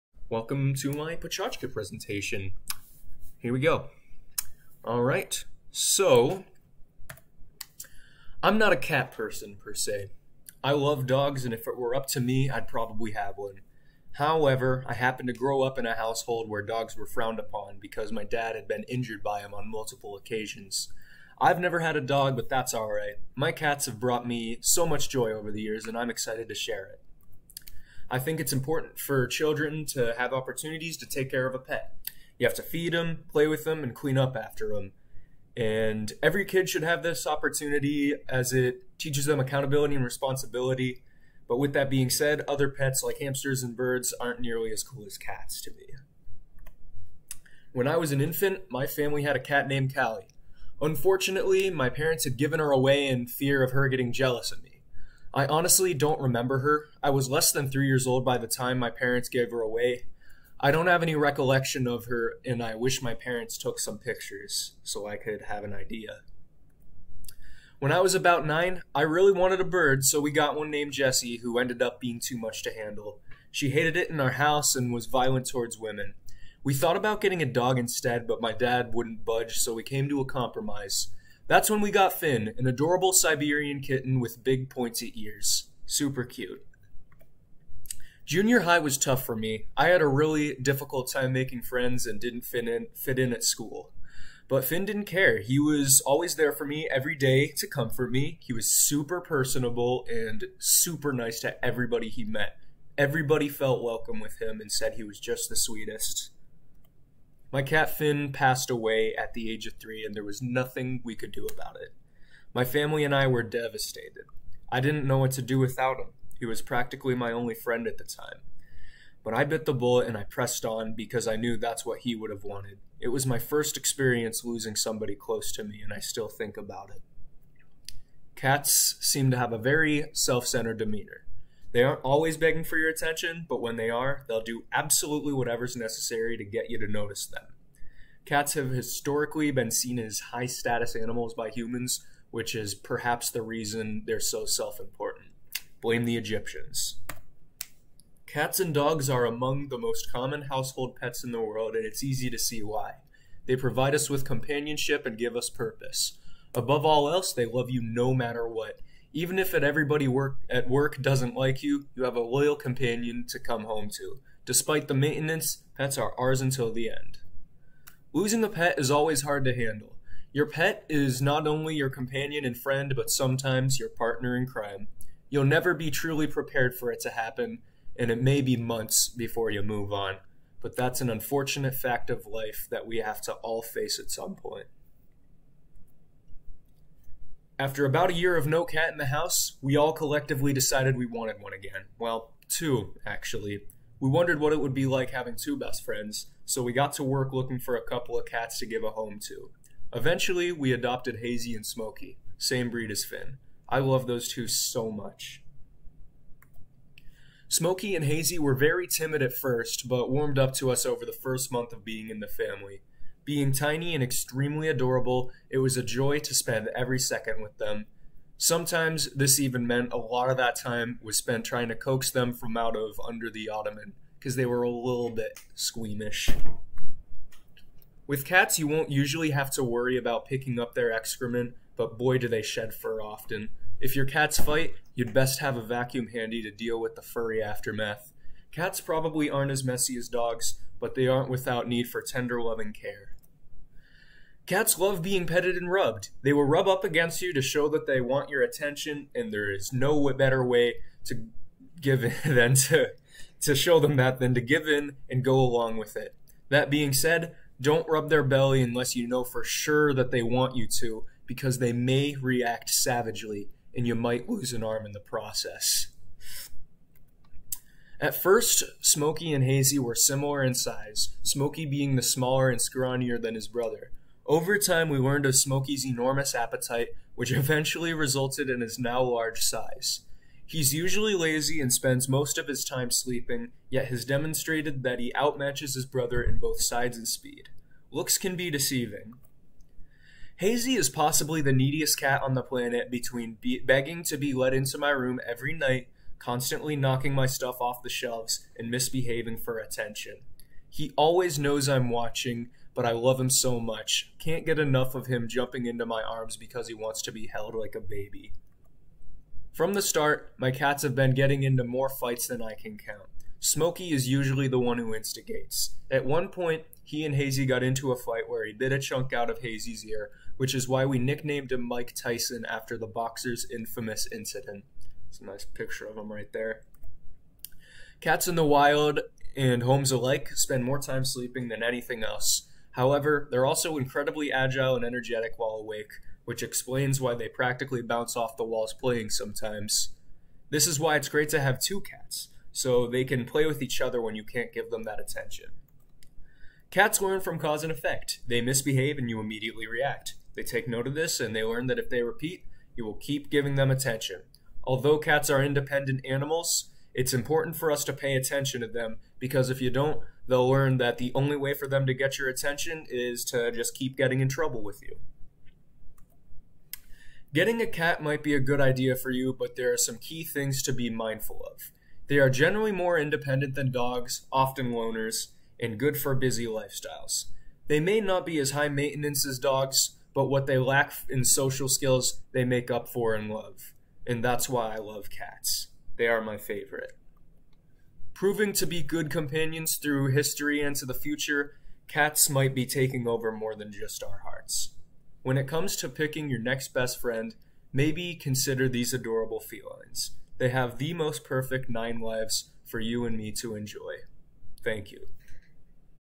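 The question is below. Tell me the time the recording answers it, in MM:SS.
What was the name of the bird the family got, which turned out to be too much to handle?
01:10.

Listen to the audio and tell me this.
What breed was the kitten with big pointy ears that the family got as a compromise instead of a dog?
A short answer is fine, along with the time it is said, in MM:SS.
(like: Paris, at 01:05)
Siberian, at 01:23.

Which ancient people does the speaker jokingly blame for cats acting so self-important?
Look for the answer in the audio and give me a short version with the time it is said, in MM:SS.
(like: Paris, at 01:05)
The Egyptians, at 02:26.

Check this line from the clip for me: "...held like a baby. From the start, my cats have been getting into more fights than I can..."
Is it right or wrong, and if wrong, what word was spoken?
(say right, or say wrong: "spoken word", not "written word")
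right.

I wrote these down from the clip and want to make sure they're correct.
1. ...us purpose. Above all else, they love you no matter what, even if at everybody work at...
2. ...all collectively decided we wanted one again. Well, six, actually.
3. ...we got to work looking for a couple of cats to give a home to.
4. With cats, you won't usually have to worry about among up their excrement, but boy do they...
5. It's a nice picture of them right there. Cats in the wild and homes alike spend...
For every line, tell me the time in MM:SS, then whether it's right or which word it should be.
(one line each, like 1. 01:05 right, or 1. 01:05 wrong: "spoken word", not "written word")
1. 02:35 right
2. 03:09 wrong: "two", not "six"
3. 03:16 right
4. 03:48 wrong: "picking", not "among"
5. 05:25 right.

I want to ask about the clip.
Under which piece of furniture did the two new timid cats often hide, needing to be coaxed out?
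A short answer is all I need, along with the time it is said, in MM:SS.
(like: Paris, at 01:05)
The ottoman, at 03:43.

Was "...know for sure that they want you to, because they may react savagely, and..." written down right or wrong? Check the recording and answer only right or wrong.
right.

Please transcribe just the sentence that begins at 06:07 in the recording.
Getting a cat might be a good idea for you, but there are some key things to be mindful of.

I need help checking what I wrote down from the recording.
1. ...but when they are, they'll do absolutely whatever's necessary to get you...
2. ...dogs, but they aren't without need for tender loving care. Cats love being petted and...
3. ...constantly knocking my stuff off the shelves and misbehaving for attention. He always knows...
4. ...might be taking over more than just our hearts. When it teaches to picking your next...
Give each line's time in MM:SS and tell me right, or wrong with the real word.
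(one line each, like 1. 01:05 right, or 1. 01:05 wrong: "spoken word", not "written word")
1. 02:13 right
2. 04:00 right
3. 04:56 right
4. 06:32 wrong: "comes", not "teaches".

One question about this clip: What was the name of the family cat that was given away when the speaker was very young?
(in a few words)
Callie.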